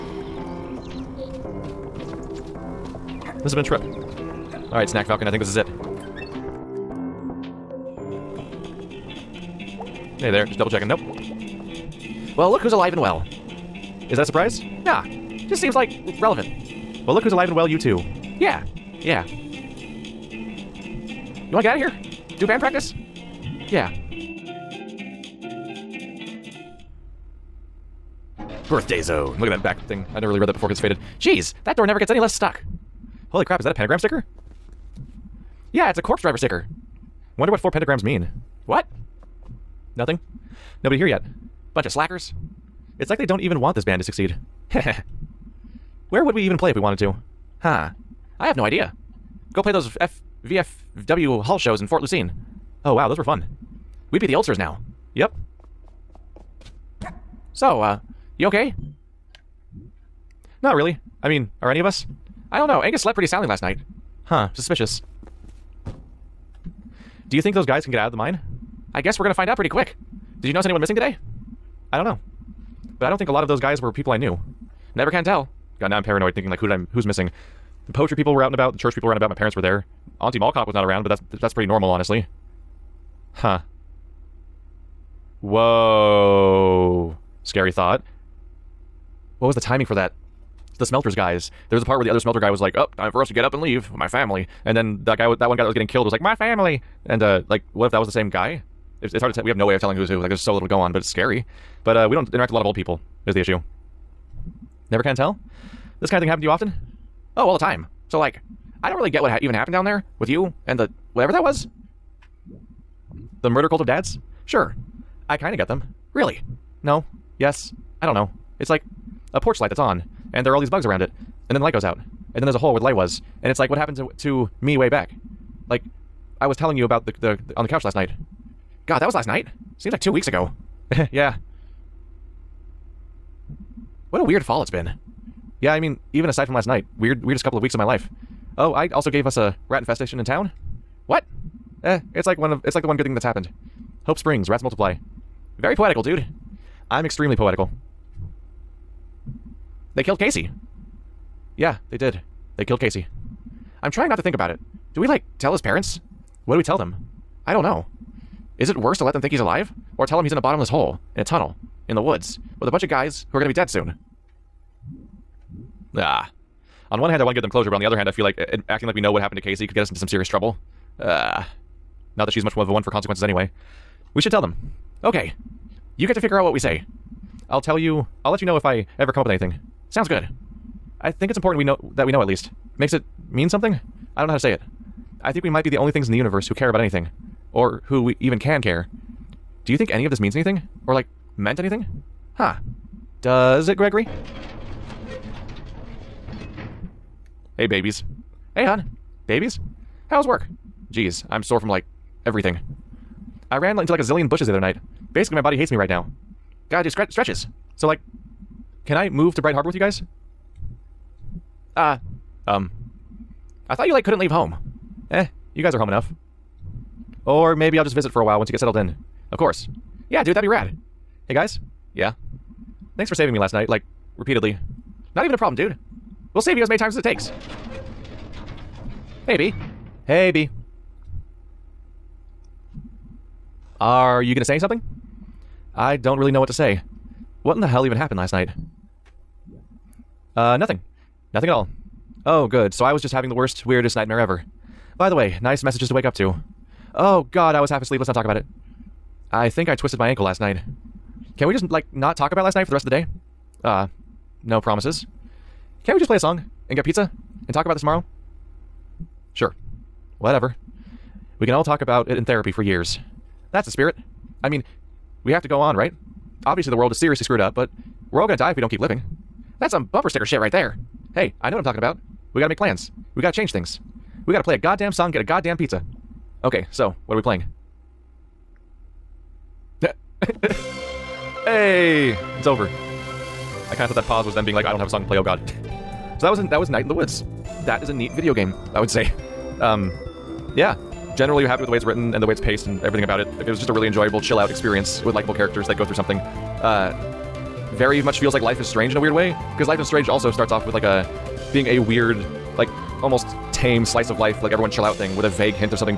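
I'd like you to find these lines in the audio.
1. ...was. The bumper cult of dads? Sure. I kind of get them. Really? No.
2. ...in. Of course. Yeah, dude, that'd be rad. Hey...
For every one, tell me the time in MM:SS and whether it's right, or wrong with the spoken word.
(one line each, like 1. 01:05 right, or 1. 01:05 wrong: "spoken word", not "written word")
1. 01:51 wrong: "murder", not "bumper"
2. 03:38 right.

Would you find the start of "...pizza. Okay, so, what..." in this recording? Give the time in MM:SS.
04:35.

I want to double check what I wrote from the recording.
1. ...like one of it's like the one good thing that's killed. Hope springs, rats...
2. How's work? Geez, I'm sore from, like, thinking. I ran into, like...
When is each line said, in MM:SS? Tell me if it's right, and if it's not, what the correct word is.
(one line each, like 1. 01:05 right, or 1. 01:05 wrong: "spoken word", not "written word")
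1. 02:22 wrong: "happened", not "killed"
2. 03:20 wrong: "everything", not "thinking".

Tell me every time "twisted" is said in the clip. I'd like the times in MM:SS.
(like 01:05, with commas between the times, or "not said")
04:09.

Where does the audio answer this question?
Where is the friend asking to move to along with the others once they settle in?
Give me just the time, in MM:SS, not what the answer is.
03:29.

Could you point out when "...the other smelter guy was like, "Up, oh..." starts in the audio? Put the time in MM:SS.
01:32.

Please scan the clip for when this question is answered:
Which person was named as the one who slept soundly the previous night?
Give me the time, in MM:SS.
01:02.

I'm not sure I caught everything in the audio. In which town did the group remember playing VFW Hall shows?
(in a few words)
Fort Lucene.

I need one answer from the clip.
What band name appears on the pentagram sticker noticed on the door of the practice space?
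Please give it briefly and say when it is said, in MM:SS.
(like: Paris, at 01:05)
Corpsedriver, at 00:36.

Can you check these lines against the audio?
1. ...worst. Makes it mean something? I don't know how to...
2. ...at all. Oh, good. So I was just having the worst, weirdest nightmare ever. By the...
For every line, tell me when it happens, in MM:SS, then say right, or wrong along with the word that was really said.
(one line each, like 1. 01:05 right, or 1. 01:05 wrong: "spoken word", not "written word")
1. 03:02 wrong: "least", not "worst"
2. 04:01 right.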